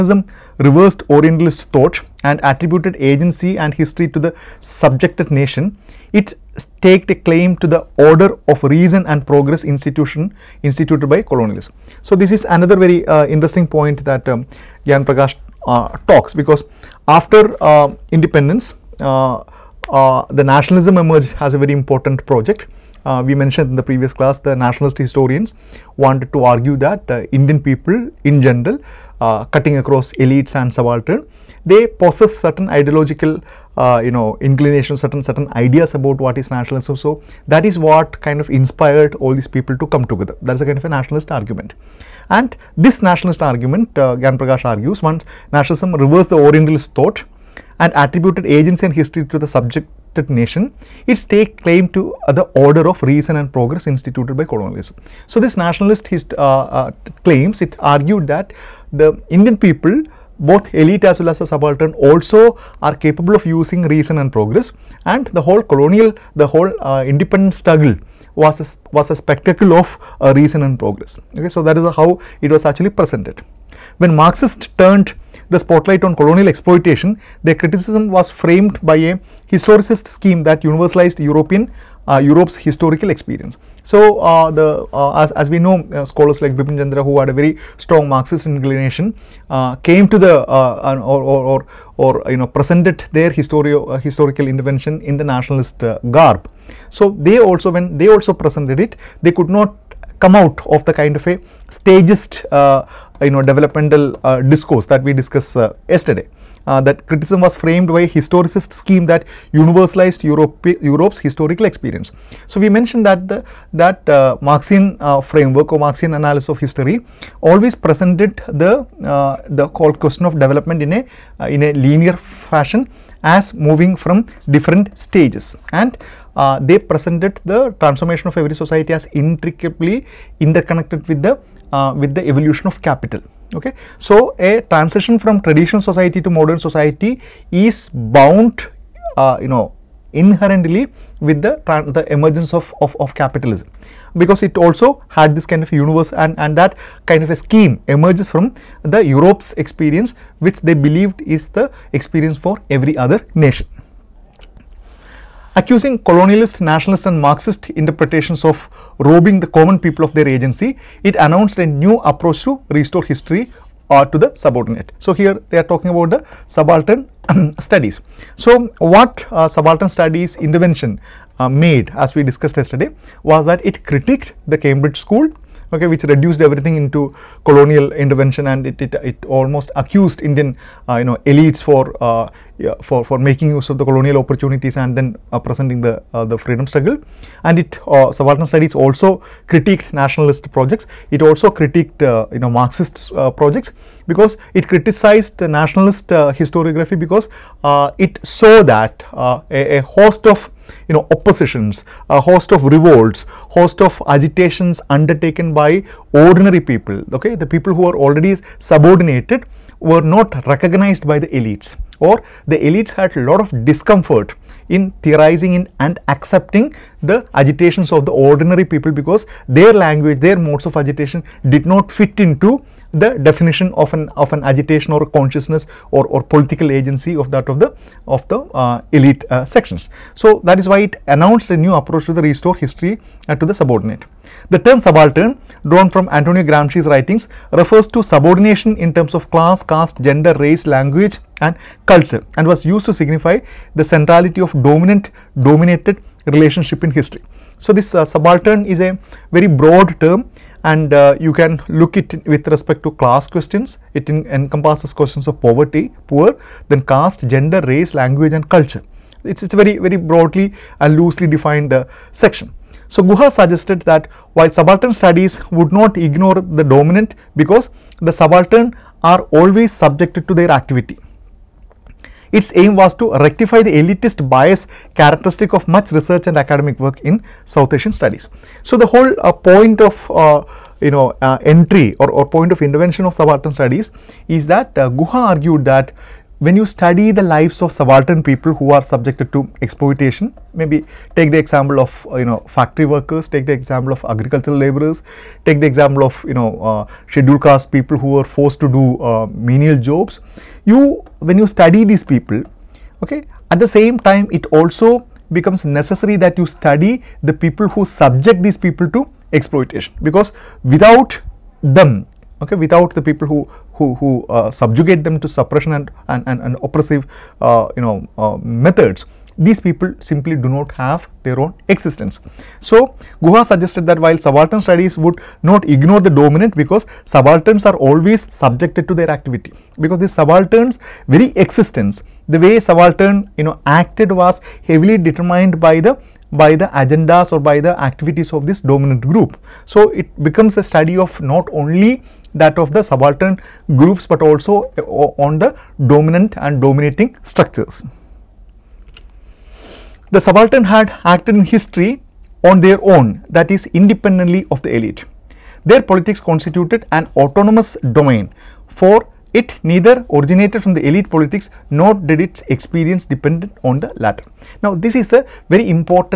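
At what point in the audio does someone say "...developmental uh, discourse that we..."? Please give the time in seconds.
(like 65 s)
103 s.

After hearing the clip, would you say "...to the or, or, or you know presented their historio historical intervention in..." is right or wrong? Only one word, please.
right.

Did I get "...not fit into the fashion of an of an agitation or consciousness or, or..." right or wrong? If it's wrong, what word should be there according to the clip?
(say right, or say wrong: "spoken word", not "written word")
wrong: "definition", not "fashion".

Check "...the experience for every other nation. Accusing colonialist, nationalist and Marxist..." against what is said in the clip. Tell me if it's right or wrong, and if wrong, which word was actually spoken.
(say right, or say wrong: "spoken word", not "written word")
right.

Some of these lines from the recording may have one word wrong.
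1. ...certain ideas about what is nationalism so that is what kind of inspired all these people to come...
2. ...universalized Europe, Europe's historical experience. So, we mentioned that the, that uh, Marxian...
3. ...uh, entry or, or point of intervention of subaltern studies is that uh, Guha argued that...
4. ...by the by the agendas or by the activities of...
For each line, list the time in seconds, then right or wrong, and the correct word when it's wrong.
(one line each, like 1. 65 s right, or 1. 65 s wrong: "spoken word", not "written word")
1. 35 s right
2. 109 s right
3. 281 s right
4. 335 s right.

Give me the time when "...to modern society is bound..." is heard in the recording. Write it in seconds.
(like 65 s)
136 s.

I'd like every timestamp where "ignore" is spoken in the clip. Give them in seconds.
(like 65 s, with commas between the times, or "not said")
265 s, 325 s.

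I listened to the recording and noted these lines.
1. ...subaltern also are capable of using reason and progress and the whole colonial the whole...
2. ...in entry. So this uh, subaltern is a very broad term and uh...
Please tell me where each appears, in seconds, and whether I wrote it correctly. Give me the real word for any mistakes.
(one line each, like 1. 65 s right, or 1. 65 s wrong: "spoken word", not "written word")
1. 61 s right
2. 246 s wrong: "history", not "entry".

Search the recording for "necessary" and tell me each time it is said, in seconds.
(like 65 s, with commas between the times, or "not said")
305 s.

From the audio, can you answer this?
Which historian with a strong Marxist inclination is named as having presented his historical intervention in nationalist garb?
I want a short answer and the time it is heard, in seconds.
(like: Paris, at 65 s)
Bipin Chandra, at 86 s.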